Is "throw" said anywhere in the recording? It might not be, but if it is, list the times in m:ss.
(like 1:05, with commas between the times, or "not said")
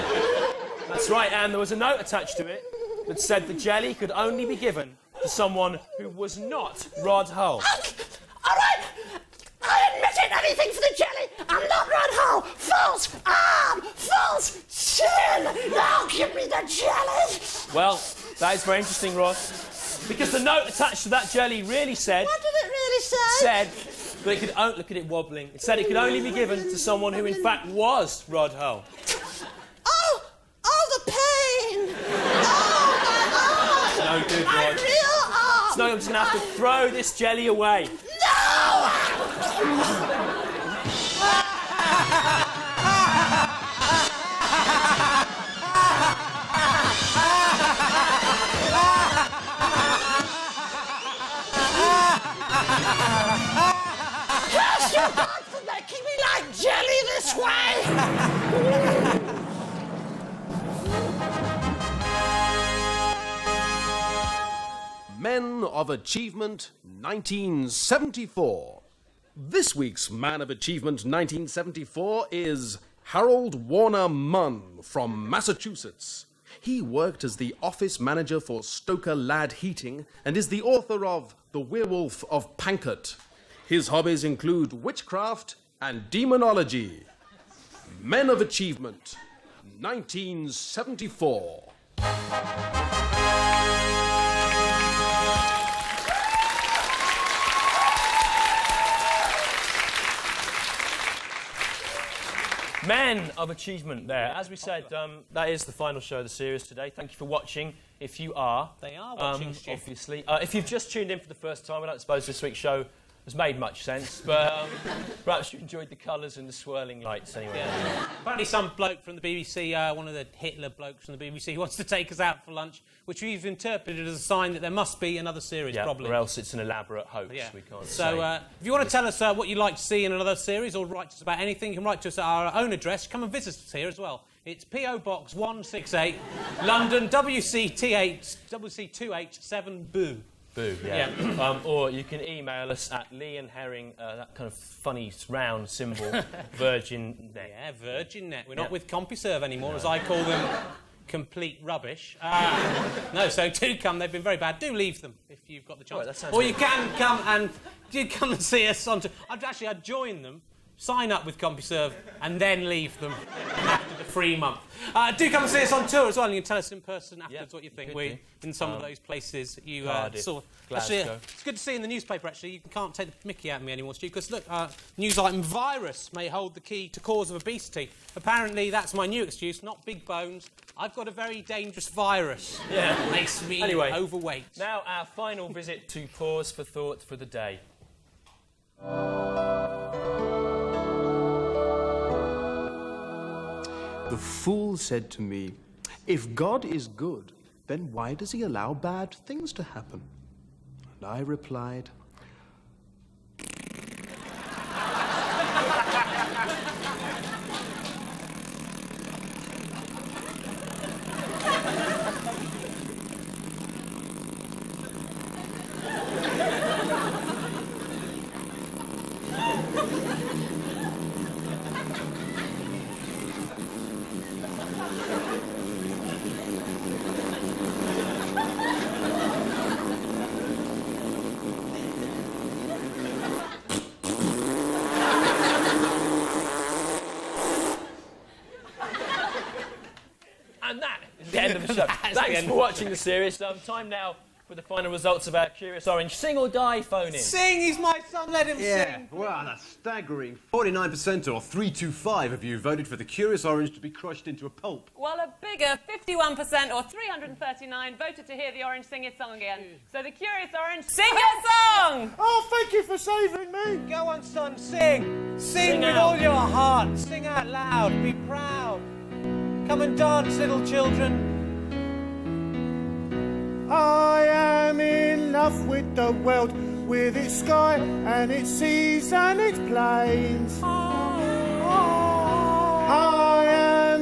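0:36.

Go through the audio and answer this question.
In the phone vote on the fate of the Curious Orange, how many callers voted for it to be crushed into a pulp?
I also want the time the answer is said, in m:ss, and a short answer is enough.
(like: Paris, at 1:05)
325, at 4:11.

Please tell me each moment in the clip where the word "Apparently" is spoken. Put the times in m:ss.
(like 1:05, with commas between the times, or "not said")
1:58, 2:58.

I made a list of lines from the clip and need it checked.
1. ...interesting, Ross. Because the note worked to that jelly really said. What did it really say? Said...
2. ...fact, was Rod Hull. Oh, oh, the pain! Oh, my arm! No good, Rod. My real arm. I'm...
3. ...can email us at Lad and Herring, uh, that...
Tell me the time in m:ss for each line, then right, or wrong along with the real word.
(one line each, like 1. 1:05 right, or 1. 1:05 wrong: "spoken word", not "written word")
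1. 0:18 wrong: "attached", not "worked"
2. 0:27 right
3. 2:22 wrong: "Lee", not "Lad".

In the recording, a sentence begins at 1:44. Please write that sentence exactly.
As we said, um, that is the final show of the series today.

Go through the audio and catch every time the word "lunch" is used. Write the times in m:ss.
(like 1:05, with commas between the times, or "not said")
2:02.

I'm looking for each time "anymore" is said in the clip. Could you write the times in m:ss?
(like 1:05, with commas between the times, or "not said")
2:29, 2:53.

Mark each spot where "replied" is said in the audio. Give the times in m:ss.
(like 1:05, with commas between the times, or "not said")
3:21.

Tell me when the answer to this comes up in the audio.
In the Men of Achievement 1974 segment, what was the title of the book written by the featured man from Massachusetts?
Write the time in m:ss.
1:21.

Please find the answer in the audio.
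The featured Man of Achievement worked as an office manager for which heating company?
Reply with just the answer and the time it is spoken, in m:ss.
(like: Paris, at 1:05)
Stoker Lad Heating, at 1:18.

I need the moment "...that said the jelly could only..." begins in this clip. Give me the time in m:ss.
0:03.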